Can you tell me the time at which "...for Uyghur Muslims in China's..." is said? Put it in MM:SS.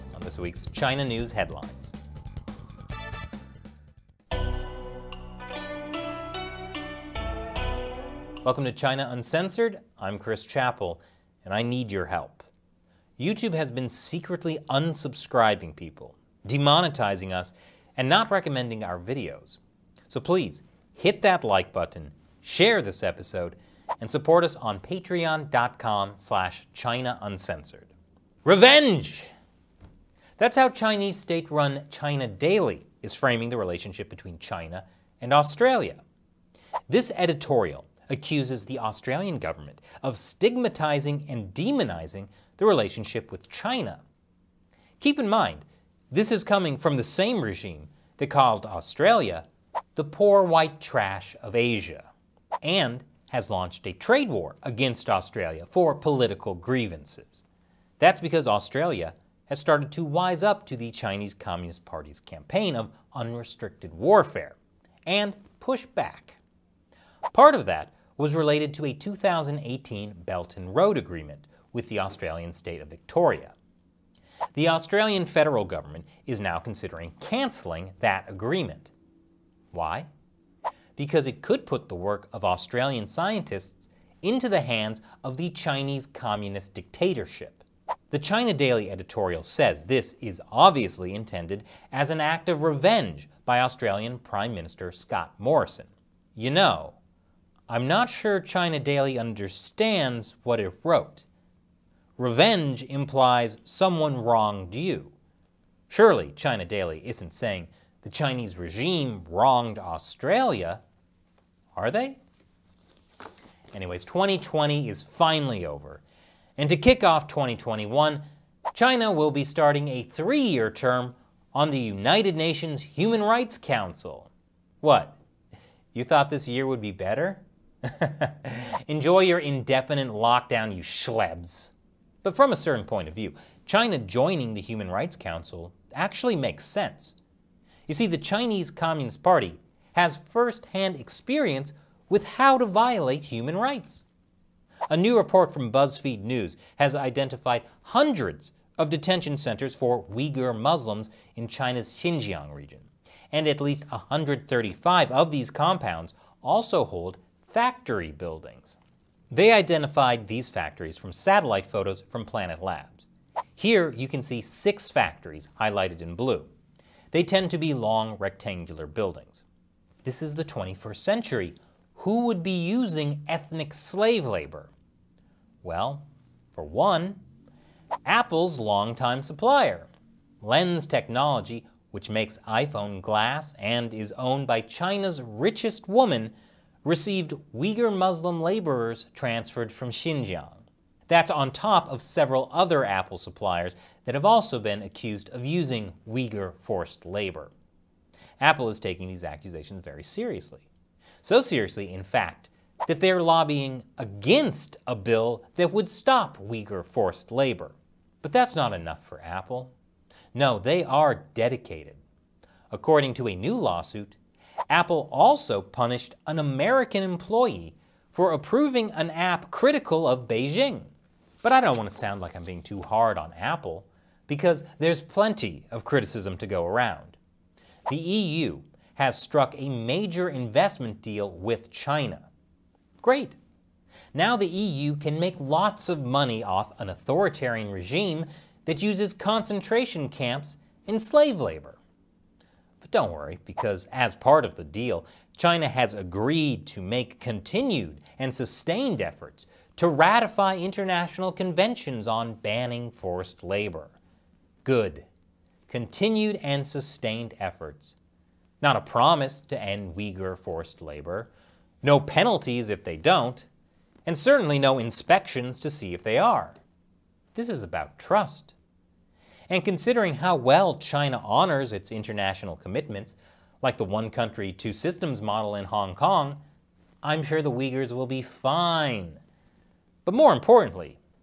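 02:29.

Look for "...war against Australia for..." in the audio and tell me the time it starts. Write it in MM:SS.
00:54.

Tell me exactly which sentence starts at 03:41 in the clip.
But I don't want to sound like I'm being too hard on Apple, because there's plenty of criticism to go around.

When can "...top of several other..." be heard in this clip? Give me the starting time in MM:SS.
03:11.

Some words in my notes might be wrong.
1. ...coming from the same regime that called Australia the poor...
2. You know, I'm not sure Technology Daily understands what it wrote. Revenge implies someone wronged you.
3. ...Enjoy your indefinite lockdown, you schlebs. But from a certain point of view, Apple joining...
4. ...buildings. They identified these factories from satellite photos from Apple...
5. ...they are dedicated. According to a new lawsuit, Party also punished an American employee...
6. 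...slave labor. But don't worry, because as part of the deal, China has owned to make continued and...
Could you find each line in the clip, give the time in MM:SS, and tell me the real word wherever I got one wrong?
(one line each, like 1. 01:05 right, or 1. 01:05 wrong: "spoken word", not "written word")
1. 00:46 right
2. 01:36 wrong: "China", not "Technology"
3. 02:08 wrong: "China", not "Apple"
4. 02:38 wrong: "Planet", not "Apple"
5. 03:30 wrong: "Apple", not "Party"
6. 04:01 wrong: "agreed", not "owned".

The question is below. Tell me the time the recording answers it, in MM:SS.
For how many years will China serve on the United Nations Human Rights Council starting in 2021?
02:00.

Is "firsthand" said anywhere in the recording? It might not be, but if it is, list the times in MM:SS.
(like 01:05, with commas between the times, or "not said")
02:20.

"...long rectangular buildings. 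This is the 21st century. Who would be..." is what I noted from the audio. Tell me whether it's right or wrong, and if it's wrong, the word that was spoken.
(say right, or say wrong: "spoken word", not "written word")
right.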